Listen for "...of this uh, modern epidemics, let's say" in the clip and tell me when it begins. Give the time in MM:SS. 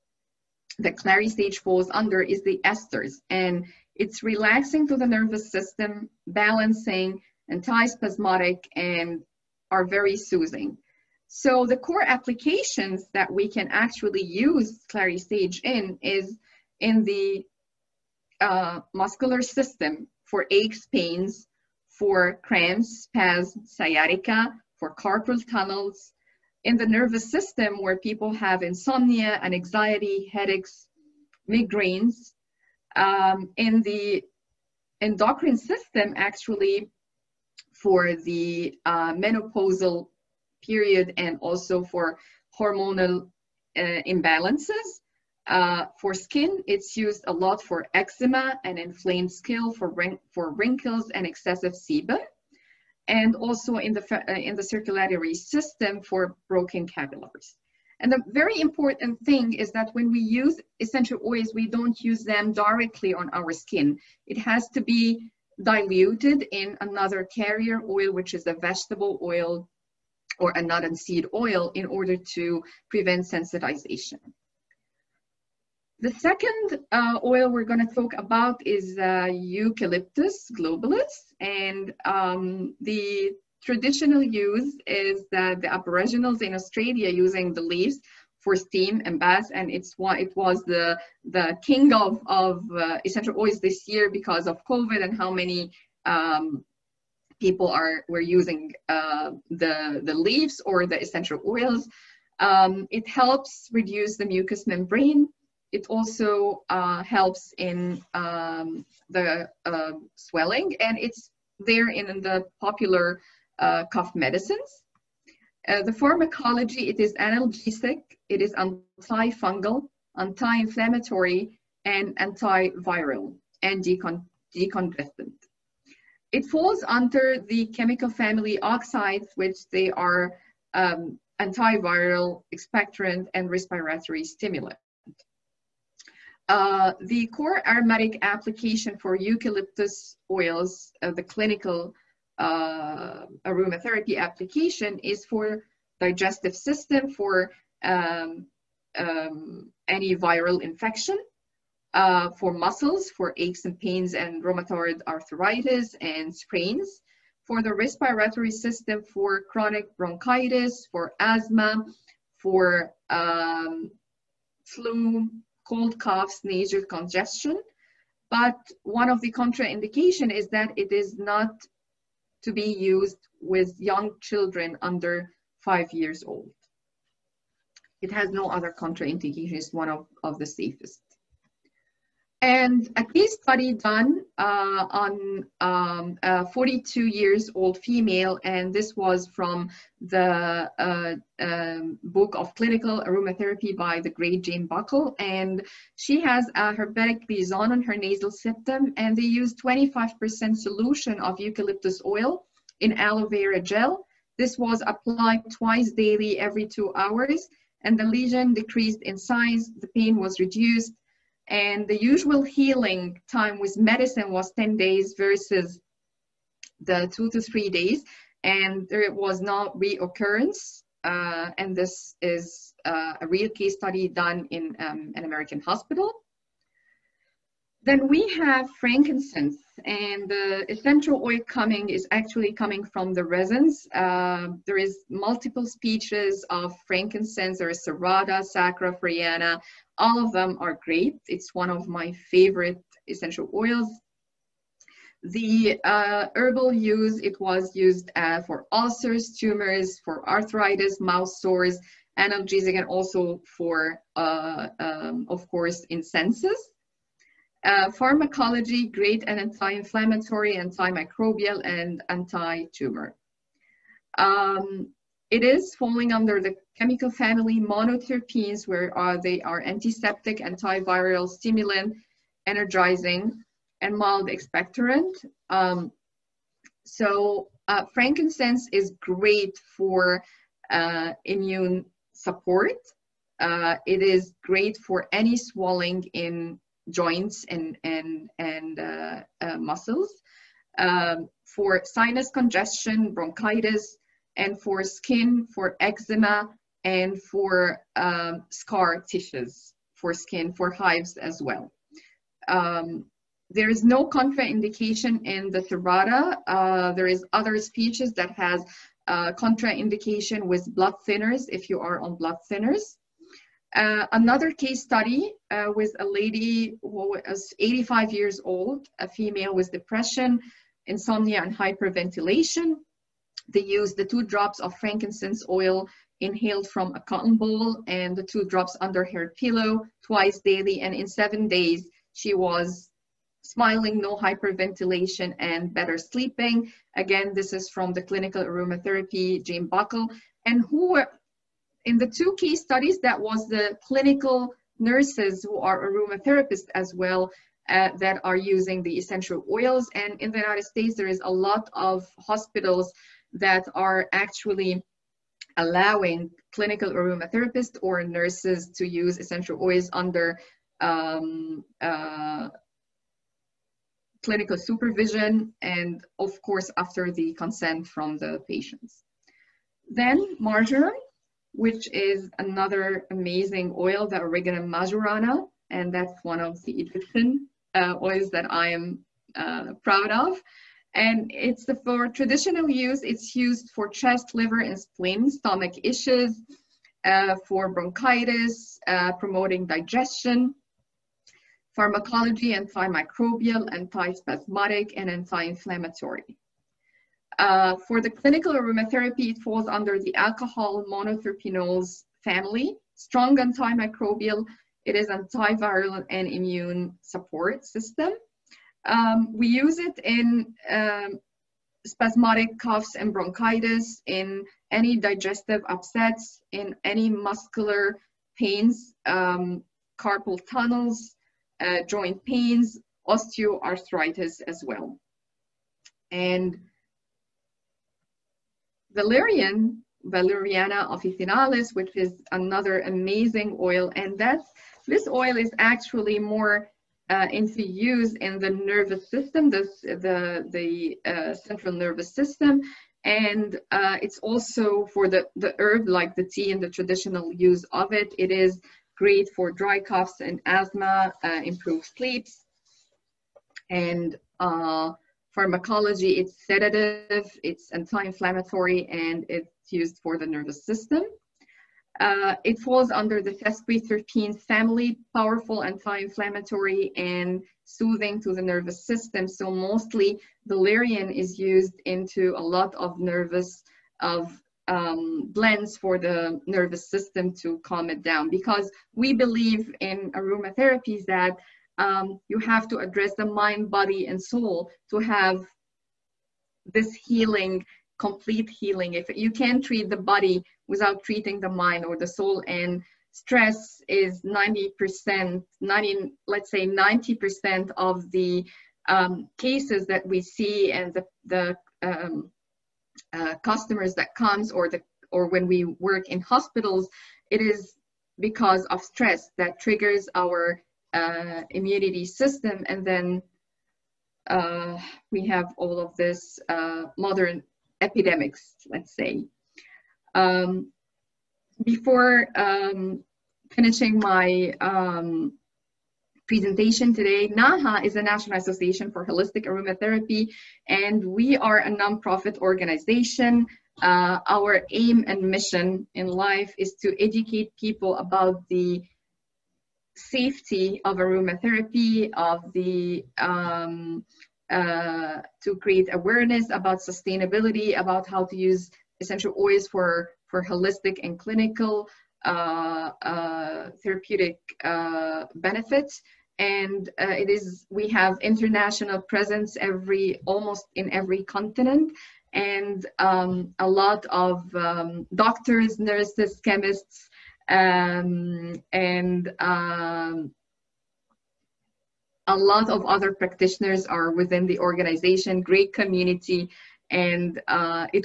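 08:35.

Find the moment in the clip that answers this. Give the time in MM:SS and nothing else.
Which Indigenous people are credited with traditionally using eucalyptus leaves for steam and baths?
01:25.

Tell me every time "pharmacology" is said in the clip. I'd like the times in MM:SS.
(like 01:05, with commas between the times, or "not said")
01:55, 04:17, 06:31, 07:35.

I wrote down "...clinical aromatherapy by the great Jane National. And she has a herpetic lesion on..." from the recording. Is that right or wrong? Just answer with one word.
wrong.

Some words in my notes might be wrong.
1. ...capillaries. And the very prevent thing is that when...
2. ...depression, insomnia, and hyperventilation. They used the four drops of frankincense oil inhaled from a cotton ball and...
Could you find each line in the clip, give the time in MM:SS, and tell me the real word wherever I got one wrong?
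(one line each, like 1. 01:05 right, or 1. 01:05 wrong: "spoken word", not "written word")
1. 00:56 wrong: "important", not "prevent"
2. 05:19 wrong: "two", not "four".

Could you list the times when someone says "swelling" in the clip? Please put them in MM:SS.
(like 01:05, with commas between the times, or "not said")
01:50, 04:45.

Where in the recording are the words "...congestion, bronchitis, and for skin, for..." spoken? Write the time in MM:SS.
04:52.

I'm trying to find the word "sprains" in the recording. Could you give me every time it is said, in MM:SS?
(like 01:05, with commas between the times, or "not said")
02:36.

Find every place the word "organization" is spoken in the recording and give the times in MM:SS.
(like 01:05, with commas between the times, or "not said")
08:52, 09:34.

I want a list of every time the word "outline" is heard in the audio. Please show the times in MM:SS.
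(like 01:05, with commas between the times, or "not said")
not said.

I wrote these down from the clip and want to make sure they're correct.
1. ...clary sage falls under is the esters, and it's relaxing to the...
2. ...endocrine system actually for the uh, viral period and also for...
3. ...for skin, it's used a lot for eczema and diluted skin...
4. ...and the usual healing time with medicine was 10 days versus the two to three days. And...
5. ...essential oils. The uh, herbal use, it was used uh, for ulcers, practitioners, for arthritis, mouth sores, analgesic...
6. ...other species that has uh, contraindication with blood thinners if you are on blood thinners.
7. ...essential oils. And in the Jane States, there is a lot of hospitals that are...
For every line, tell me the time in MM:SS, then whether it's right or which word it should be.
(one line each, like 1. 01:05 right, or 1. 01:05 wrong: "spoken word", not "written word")
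1. 00:00 right
2. 00:35 wrong: "menopausal", not "viral"
3. 00:45 wrong: "inflamed", not "diluted"
4. 03:31 right
5. 04:03 wrong: "tumors", not "practitioners"
6. 05:07 right
7. 05:48 wrong: "United", not "Jane".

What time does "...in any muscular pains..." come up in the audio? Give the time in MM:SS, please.
06:56.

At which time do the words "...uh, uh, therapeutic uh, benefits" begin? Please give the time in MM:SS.
09:12.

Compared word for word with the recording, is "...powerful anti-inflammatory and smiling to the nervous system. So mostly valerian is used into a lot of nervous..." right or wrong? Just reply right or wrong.
wrong.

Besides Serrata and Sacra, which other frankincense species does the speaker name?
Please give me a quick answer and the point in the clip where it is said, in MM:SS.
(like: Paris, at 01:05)
Frereana, at 03:58.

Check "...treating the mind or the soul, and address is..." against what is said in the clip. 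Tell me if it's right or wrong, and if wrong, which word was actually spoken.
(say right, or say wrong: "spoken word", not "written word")
wrong: "stress", not "address".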